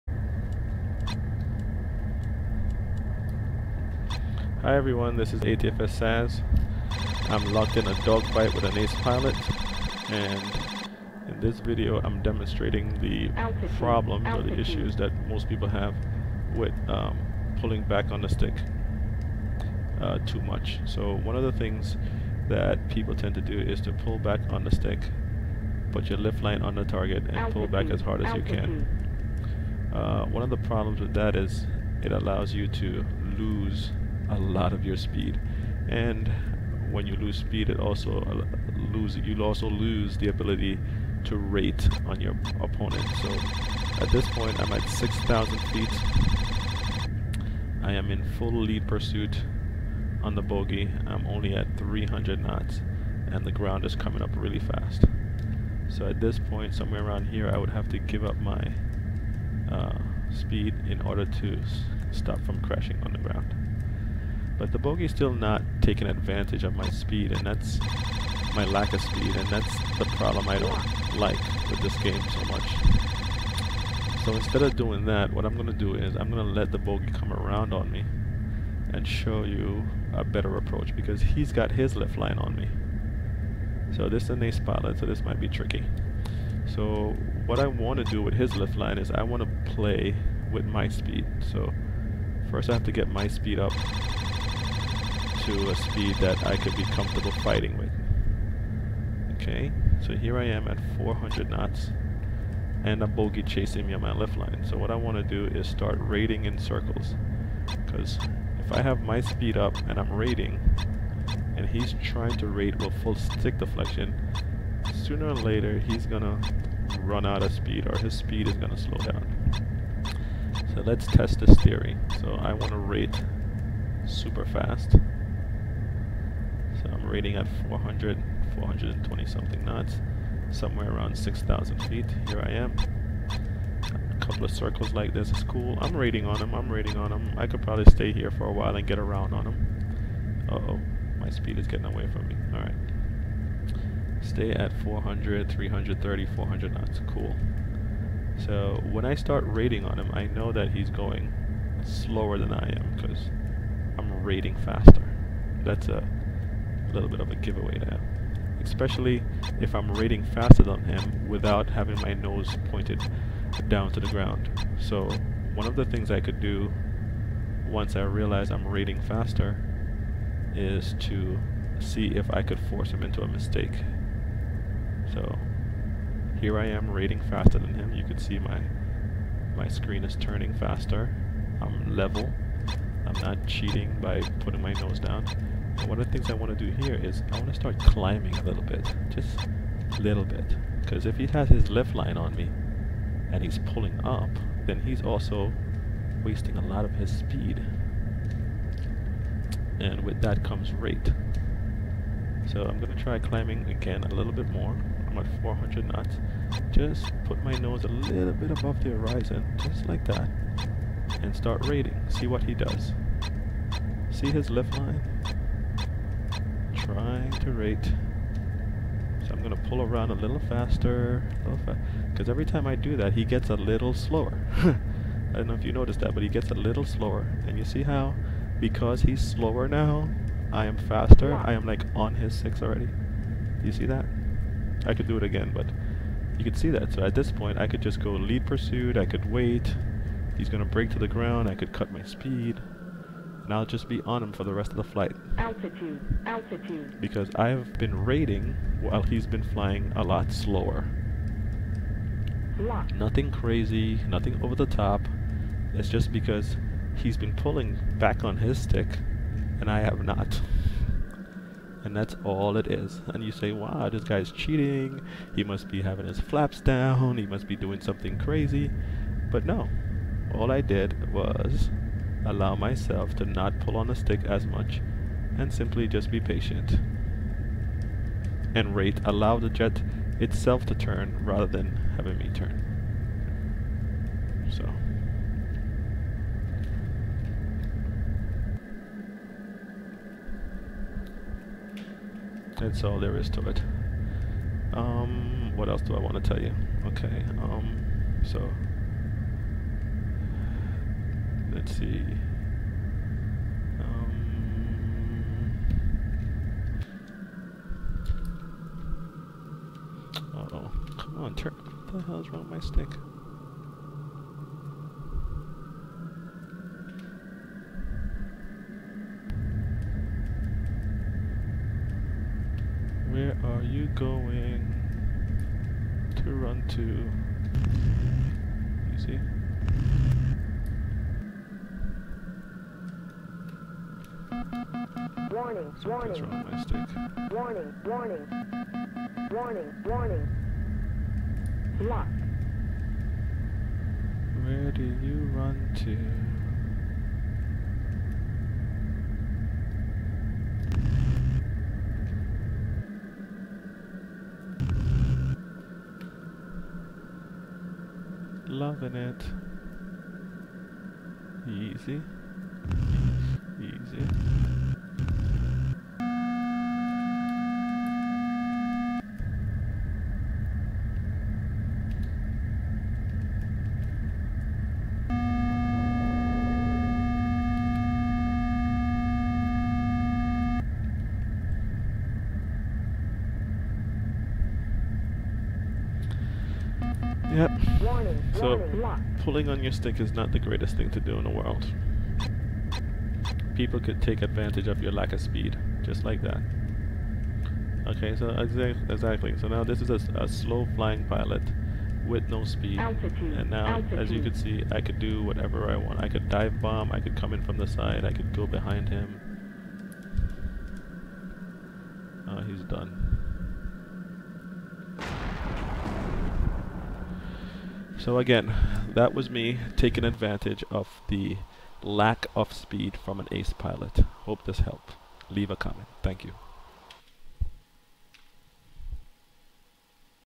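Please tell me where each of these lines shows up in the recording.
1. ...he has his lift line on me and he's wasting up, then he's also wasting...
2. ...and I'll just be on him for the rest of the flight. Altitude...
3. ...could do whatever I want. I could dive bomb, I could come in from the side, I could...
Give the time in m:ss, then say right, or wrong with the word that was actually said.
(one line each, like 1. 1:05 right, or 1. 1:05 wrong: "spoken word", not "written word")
1. 3:11 wrong: "pulling", not "wasting"
2. 4:03 right
3. 6:44 right.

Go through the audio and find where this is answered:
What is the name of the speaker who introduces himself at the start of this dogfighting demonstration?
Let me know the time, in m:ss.
0:05.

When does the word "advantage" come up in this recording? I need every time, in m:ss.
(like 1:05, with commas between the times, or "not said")
1:06, 6:34, 7:00.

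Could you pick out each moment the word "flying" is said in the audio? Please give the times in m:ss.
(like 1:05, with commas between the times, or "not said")
4:09, 6:40.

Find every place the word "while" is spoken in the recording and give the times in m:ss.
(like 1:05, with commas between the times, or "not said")
2:18, 4:08.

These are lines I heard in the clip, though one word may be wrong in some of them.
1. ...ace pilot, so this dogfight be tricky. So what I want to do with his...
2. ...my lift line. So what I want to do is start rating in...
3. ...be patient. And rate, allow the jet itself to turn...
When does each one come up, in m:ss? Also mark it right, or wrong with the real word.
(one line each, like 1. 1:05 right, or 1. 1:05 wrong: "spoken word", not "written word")
1. 1:24 wrong: "might", not "dogfight"
2. 1:44 right
3. 4:36 right.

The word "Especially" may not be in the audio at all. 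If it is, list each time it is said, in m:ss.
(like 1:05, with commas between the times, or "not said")
2:38.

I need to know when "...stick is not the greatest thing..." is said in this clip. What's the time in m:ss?
6:29.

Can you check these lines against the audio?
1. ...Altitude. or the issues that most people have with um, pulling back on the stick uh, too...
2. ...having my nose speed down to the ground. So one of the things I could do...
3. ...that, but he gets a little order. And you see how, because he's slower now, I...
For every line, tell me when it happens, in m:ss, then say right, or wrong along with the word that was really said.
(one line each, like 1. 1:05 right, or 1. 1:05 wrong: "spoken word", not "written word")
1. 0:14 right
2. 2:41 wrong: "pointed", not "speed"
3. 3:46 wrong: "slower", not "order".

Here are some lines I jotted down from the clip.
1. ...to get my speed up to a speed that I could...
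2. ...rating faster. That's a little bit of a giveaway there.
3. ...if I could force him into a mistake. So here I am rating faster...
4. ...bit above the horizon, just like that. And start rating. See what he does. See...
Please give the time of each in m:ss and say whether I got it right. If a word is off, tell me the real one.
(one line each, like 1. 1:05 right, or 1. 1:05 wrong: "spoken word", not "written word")
1. 1:32 right
2. 2:34 right
3. 2:52 right
4. 3:28 right.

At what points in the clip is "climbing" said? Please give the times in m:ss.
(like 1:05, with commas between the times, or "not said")
3:07, 3:23.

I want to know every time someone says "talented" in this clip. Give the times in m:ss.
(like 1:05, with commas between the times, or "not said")
not said.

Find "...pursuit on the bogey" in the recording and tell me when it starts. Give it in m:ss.
0:48.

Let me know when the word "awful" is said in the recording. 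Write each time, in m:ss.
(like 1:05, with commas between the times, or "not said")
not said.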